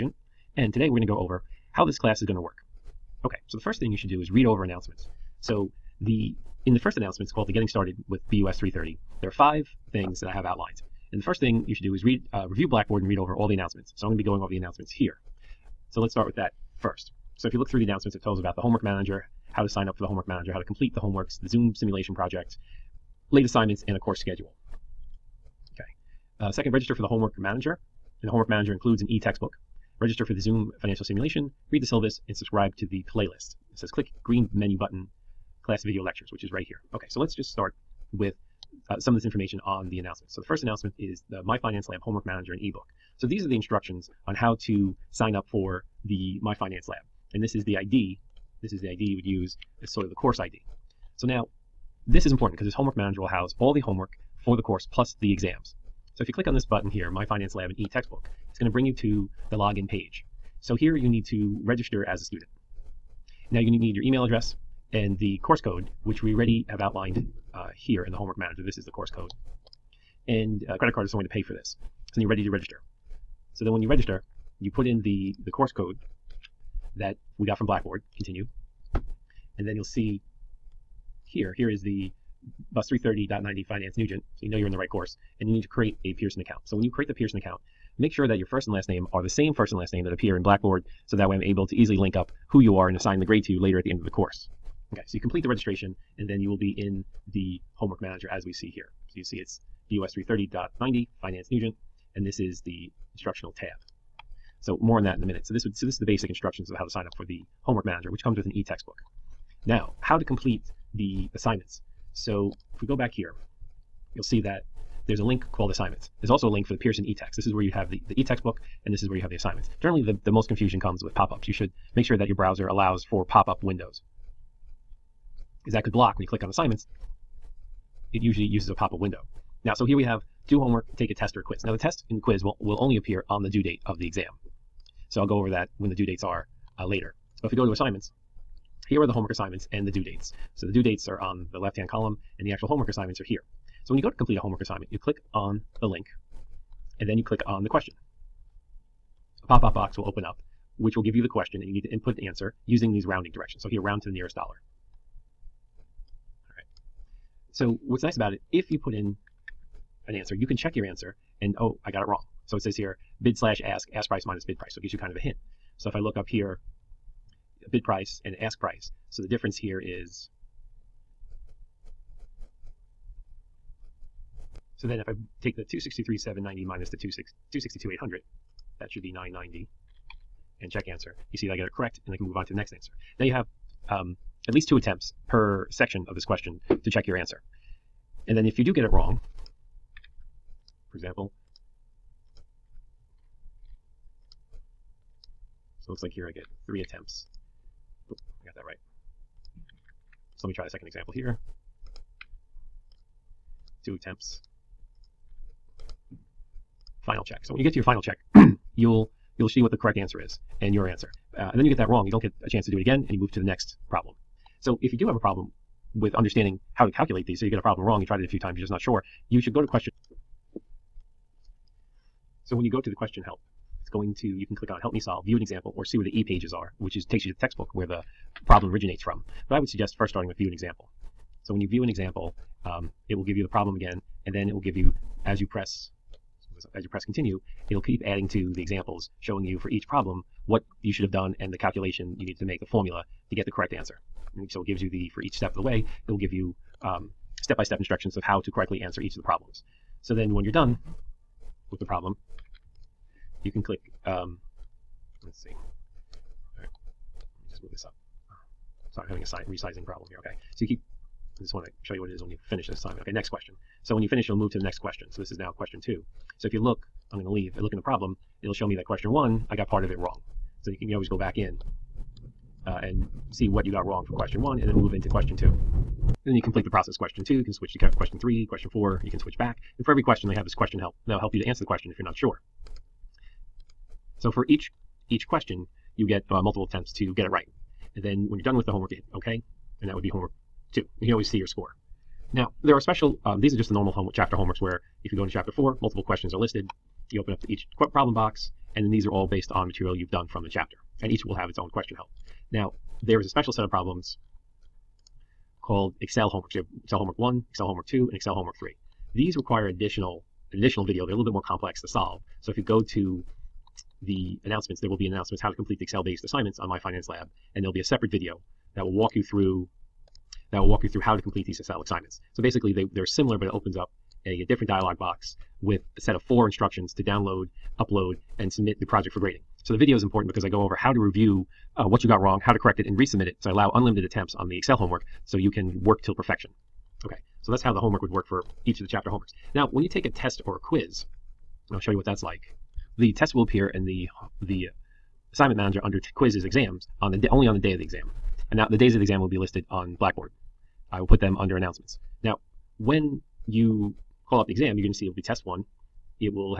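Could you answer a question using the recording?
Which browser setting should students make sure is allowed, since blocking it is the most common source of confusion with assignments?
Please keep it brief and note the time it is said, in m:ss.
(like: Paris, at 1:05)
Pop-up windows, at 2:03.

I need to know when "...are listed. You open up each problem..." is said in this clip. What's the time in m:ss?
4:56.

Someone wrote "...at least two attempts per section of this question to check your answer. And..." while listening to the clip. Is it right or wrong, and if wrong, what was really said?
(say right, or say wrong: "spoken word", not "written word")
right.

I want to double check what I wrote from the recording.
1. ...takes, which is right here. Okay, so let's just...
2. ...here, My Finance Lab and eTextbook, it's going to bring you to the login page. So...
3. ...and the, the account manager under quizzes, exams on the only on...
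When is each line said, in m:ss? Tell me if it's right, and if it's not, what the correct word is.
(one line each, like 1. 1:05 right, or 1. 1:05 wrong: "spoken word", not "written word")
1. 0:36 wrong: "lectures", not "takes"
2. 0:56 right
3. 5:43 wrong: "assignment", not "account".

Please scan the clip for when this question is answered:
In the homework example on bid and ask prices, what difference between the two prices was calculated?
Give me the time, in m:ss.
2:59.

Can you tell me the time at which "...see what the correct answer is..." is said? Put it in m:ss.
3:29.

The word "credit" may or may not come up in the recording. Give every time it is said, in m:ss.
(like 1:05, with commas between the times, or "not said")
1:10.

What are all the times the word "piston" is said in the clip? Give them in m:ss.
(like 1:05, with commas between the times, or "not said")
not said.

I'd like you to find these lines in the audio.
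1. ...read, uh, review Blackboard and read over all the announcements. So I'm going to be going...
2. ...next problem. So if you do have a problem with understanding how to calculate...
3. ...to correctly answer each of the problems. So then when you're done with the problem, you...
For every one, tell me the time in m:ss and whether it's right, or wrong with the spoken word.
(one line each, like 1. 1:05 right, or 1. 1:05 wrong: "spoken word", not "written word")
1. 0:12 right
2. 3:33 right
3. 4:08 right.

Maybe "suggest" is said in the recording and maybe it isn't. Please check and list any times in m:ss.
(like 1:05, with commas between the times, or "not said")
3:49.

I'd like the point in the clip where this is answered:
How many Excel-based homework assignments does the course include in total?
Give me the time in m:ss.
5:08.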